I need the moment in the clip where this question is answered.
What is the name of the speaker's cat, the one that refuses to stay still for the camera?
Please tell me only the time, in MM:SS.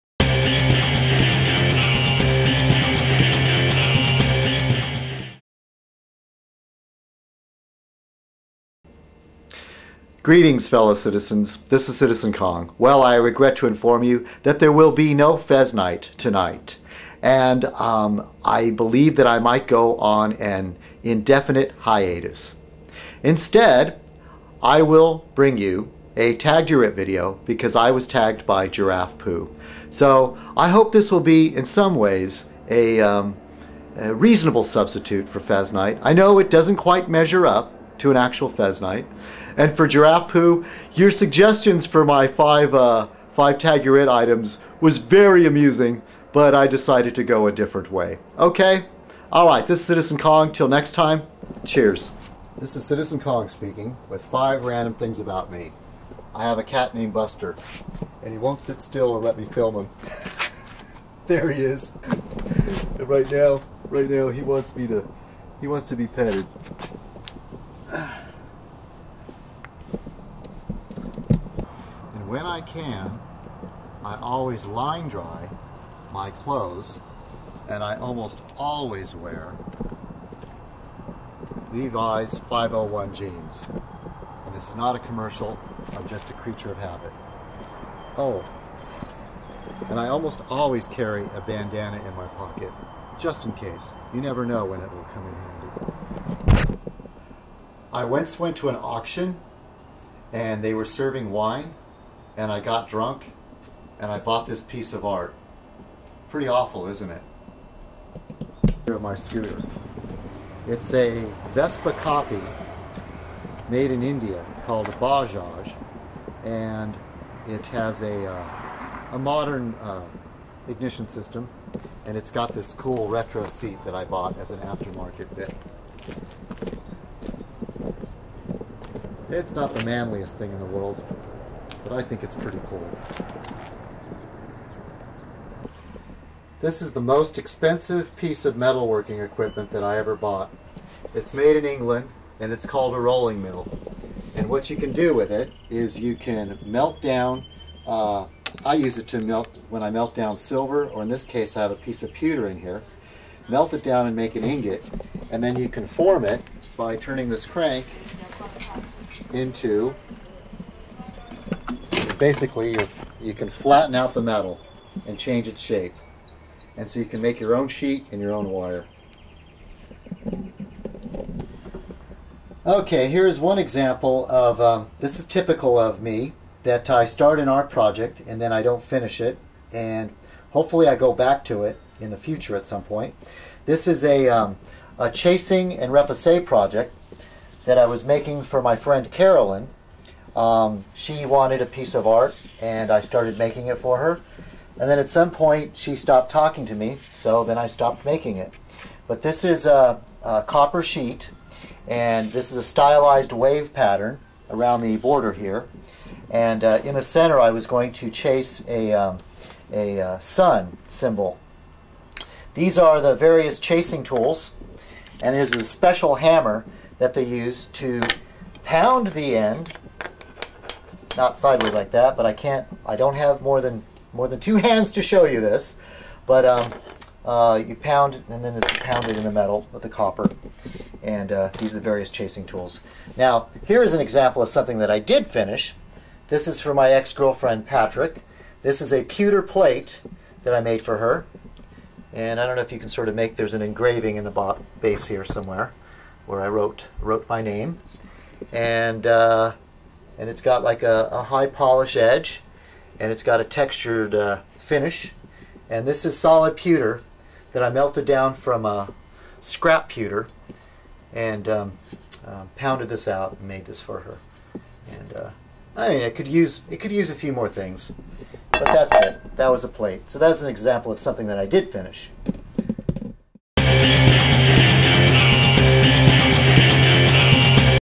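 00:57.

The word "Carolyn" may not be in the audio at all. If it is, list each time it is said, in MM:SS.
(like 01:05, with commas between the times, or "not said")
03:09.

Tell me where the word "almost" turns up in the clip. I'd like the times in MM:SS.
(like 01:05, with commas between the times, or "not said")
01:17, 01:30.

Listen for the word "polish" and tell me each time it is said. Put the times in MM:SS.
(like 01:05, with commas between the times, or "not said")
04:11.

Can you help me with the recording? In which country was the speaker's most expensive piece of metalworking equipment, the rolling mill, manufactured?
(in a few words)
England.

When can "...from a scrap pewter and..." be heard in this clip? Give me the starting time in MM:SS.
04:18.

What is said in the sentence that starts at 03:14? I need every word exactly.
And then at some point, she stopped talking to me, so then I stopped making it.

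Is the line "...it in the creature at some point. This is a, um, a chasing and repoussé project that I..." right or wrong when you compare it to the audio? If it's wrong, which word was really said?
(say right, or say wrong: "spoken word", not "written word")
wrong: "future", not "creature".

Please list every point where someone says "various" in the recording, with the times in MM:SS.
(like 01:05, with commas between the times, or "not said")
03:33, 03:51.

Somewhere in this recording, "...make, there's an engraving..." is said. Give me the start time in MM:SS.
04:03.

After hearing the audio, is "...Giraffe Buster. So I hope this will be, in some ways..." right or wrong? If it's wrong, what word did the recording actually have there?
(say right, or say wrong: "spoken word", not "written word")
wrong: "Poo", not "Buster".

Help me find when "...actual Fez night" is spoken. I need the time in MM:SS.
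00:38.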